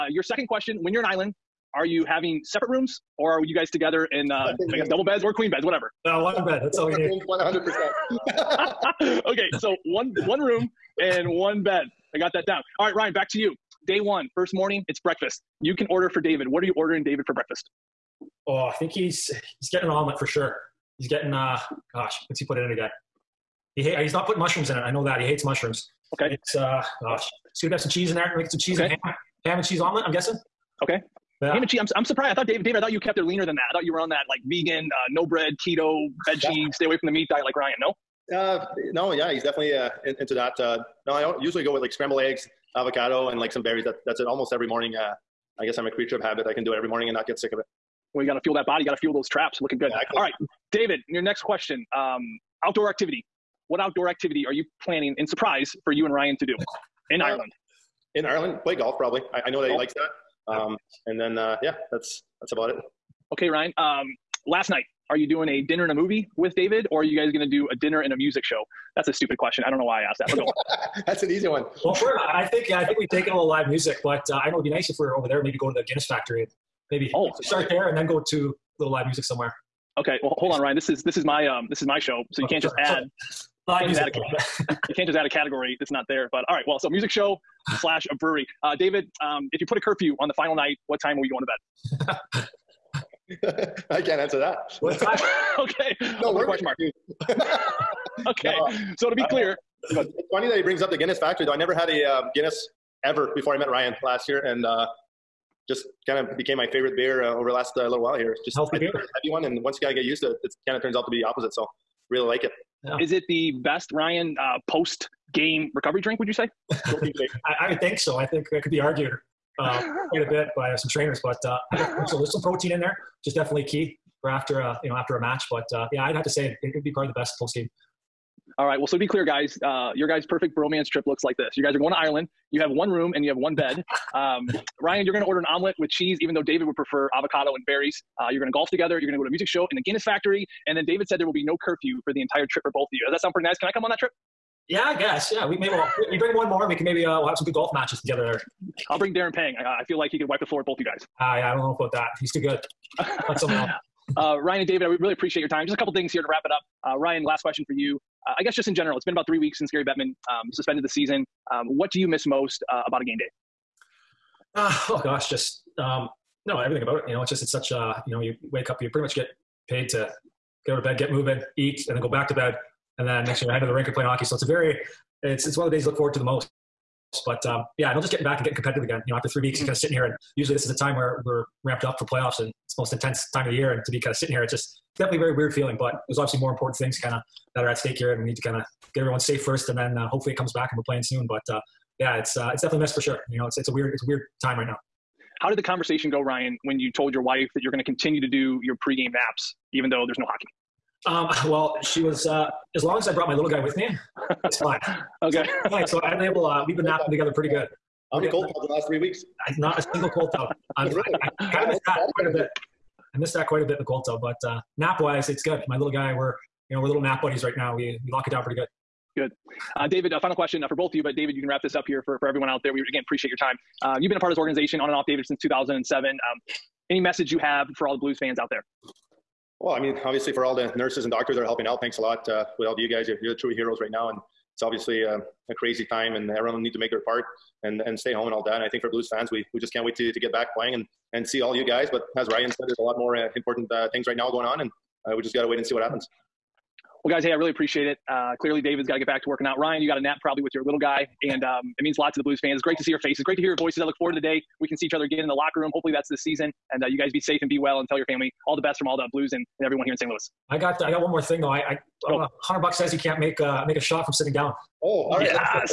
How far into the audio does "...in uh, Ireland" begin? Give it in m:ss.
0:57.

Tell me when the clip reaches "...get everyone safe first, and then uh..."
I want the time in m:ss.
3:08.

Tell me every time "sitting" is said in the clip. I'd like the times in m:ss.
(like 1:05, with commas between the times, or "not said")
2:59, 3:04, 4:24.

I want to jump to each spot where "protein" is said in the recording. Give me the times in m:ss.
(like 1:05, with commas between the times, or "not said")
2:02.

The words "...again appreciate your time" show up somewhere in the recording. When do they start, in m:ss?
3:42.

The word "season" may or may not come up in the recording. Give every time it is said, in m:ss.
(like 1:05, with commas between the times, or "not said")
2:40, 4:16.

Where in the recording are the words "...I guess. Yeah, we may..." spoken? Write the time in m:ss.
2:24.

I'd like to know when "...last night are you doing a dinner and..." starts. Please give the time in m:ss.
1:04.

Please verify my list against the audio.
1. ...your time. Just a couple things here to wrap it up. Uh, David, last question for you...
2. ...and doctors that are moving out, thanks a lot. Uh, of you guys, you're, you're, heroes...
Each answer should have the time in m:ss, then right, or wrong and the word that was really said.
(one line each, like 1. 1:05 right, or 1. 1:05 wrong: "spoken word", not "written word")
1. 2:35 wrong: "Ryan", not "David"
2. 3:51 wrong: "helping", not "moving".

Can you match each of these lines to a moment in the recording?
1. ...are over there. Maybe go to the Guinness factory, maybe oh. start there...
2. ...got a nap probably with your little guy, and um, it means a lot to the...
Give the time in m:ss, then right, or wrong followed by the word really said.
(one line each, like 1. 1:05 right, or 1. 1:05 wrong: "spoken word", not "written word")
1. 1:15 right
2. 4:09 right.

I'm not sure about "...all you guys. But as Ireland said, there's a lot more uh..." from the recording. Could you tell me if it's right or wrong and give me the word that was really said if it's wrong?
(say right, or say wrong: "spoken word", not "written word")
wrong: "Ryan", not "Ireland".